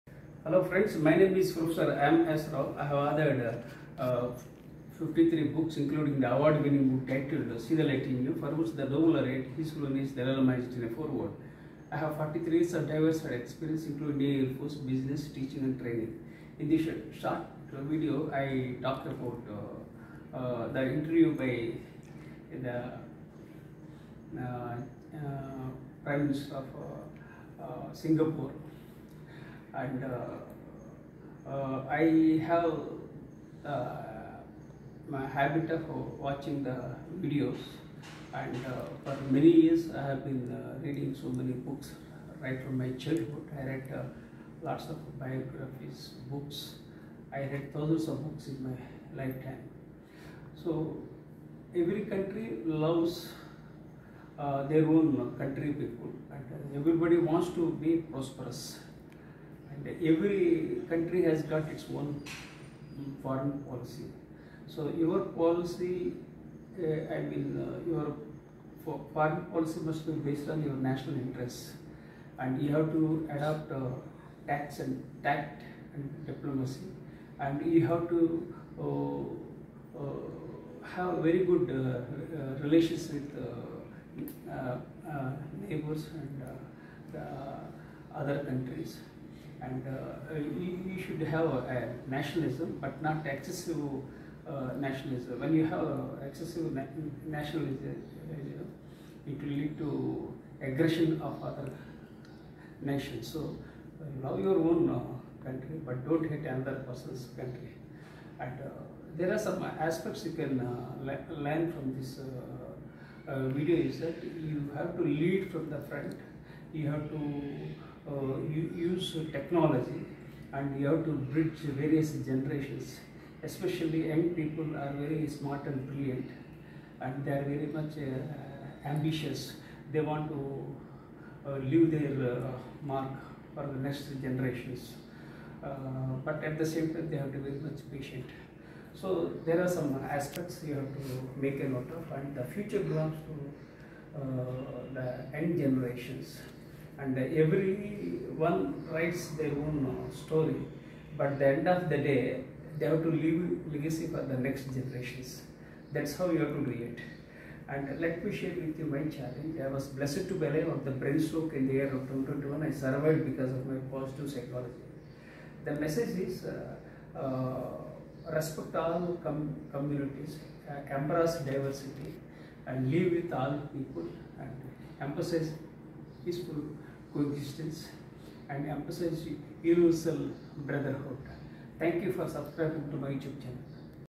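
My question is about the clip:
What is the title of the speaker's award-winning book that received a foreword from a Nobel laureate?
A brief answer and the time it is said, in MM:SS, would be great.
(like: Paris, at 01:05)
See the Light in You, at 00:07.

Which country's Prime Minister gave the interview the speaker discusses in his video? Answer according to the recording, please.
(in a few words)
Singapore.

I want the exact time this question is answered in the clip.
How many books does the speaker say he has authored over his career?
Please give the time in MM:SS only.
00:04.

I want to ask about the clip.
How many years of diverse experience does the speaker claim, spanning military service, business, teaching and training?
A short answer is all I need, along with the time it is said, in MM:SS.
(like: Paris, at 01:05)
43, at 00:12.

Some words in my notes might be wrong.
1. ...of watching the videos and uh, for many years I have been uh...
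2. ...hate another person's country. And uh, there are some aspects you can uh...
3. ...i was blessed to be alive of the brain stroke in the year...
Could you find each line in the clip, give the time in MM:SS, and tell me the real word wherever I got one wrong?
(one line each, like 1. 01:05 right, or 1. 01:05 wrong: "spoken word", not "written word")
1. 00:35 right
2. 01:46 right
3. 02:39 right.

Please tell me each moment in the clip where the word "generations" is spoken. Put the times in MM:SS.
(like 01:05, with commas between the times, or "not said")
02:02, 02:14, 02:25, 02:34.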